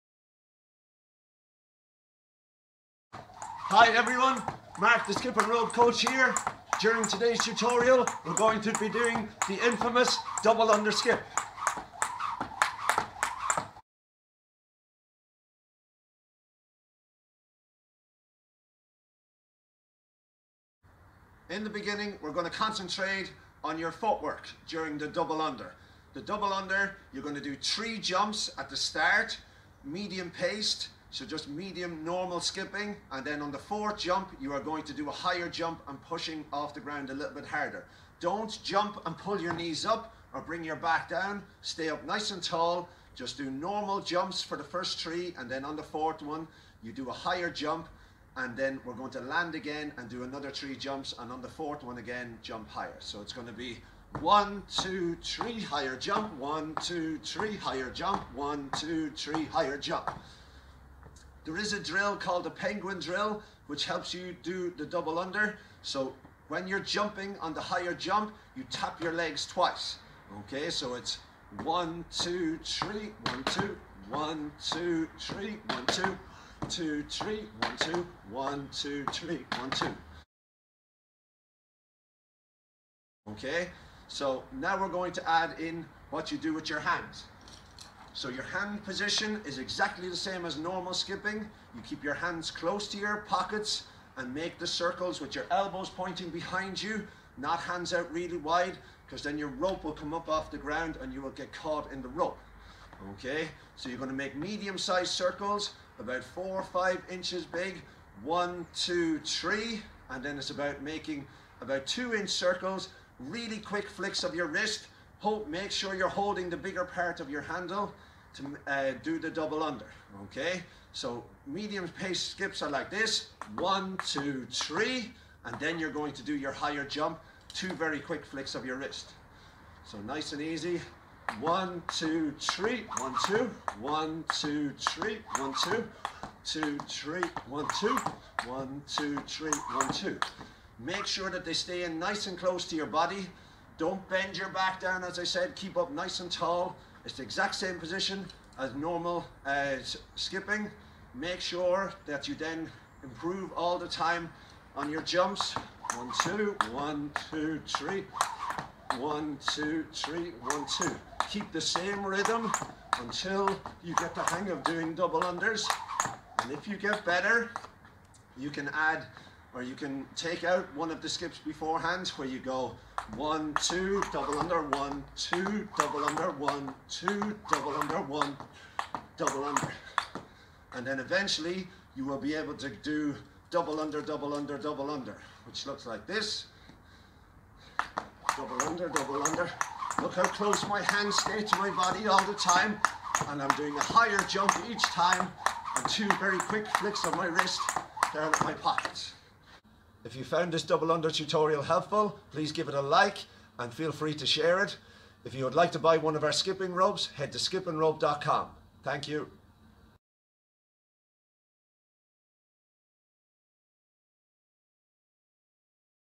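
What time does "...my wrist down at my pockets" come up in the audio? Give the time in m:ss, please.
3:17.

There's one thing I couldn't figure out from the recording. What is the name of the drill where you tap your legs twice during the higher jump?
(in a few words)
penguin drill.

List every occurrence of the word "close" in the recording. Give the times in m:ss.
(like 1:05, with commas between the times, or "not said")
1:32, 2:22, 3:10.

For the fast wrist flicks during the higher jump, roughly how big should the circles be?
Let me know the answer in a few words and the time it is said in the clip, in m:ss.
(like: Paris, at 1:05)
2 inches, at 1:51.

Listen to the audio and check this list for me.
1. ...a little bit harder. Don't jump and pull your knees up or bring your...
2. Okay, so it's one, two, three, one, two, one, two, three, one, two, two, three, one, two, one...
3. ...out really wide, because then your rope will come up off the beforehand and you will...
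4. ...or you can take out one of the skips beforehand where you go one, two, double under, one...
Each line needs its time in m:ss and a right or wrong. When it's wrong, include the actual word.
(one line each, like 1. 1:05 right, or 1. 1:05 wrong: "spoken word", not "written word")
1. 0:37 right
2. 1:10 right
3. 1:37 wrong: "ground", not "beforehand"
4. 2:49 right.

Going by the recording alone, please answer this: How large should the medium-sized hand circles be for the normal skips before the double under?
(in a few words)
4 or 5 inches.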